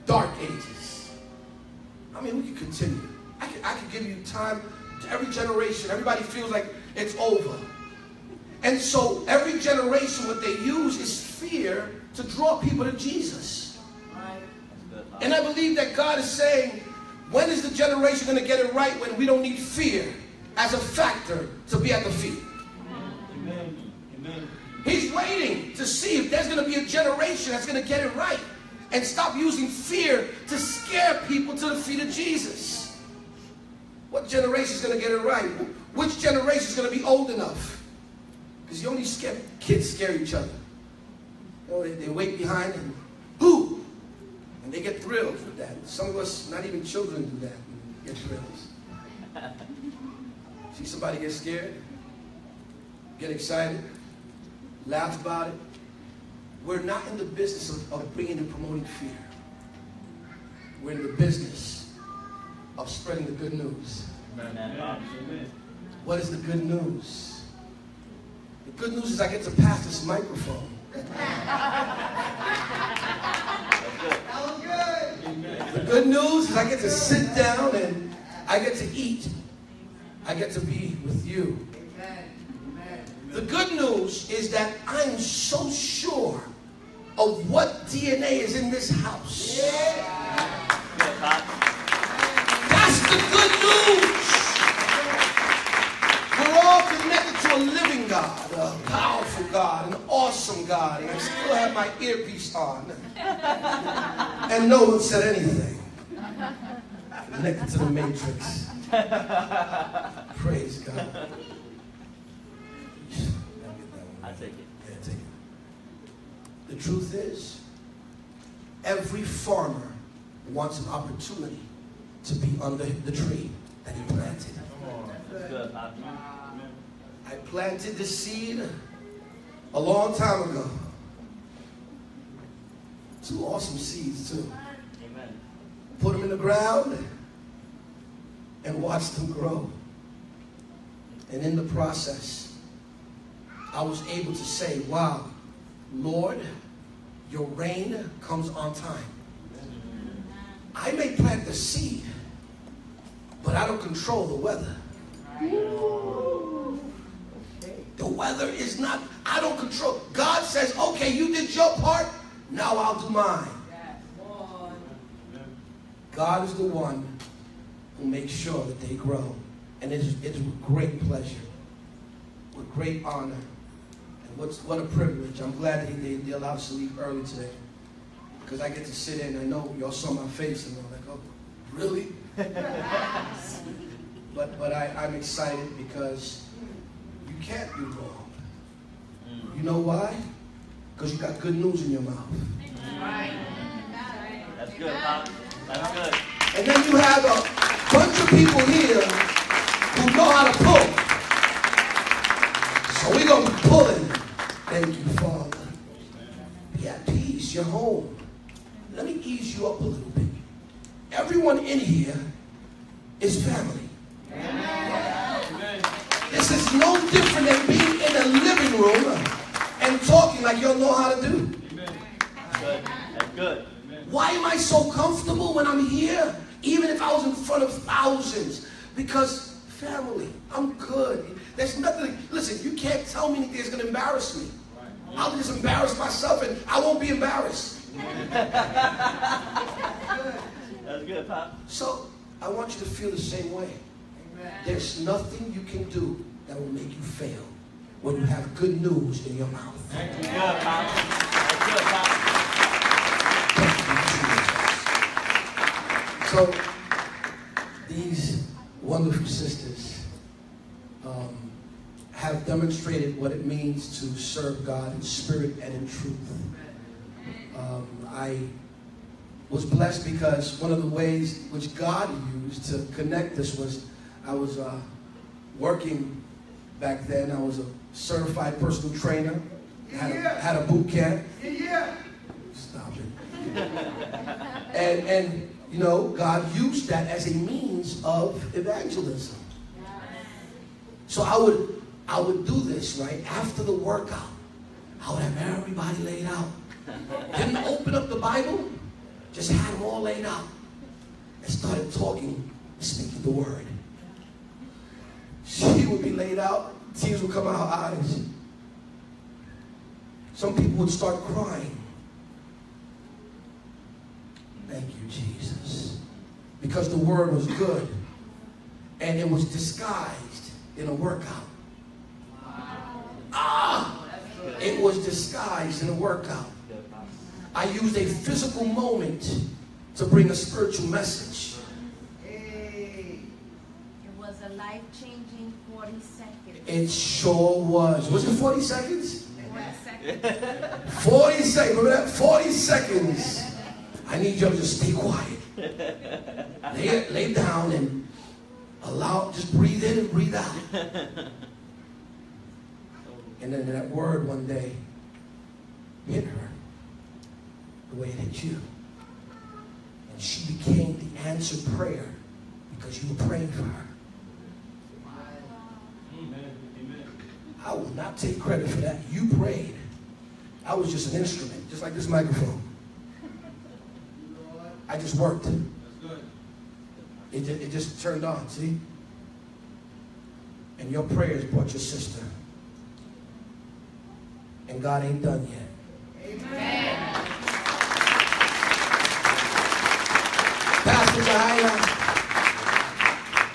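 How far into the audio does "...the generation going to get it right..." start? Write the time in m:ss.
0:17.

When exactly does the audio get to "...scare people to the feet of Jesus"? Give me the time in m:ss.
0:30.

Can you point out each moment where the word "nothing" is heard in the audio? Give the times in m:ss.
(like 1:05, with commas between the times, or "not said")
3:51, 4:05.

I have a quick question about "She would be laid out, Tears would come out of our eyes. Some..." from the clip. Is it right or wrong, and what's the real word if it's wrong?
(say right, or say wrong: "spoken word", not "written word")
right.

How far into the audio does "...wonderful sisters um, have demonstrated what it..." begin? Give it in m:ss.
4:18.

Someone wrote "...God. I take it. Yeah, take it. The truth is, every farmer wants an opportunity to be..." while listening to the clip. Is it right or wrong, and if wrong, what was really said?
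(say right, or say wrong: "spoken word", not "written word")
right.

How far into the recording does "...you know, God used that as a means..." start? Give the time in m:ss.
4:45.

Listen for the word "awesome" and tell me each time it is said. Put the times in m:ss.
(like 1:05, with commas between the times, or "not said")
1:40, 2:13.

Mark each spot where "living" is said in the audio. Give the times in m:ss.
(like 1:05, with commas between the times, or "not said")
1:37, 3:38.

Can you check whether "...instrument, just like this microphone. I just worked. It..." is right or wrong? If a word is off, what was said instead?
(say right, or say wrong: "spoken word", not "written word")
right.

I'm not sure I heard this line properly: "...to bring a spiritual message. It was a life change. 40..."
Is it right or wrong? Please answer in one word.
right.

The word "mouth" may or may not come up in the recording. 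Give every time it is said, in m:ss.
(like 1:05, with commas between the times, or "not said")
3:12, 4:09.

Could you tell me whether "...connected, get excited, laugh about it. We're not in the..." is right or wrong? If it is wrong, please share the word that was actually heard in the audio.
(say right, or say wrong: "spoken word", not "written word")
wrong: "scared", not "connected".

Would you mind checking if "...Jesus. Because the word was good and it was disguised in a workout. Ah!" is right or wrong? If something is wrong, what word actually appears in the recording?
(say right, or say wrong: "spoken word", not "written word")
right.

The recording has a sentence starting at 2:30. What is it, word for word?
I may plant the seed, but I don't control the weather.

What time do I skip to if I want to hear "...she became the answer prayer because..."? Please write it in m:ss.
6:00.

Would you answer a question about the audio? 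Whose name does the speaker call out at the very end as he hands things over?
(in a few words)
Pastor Yahaira.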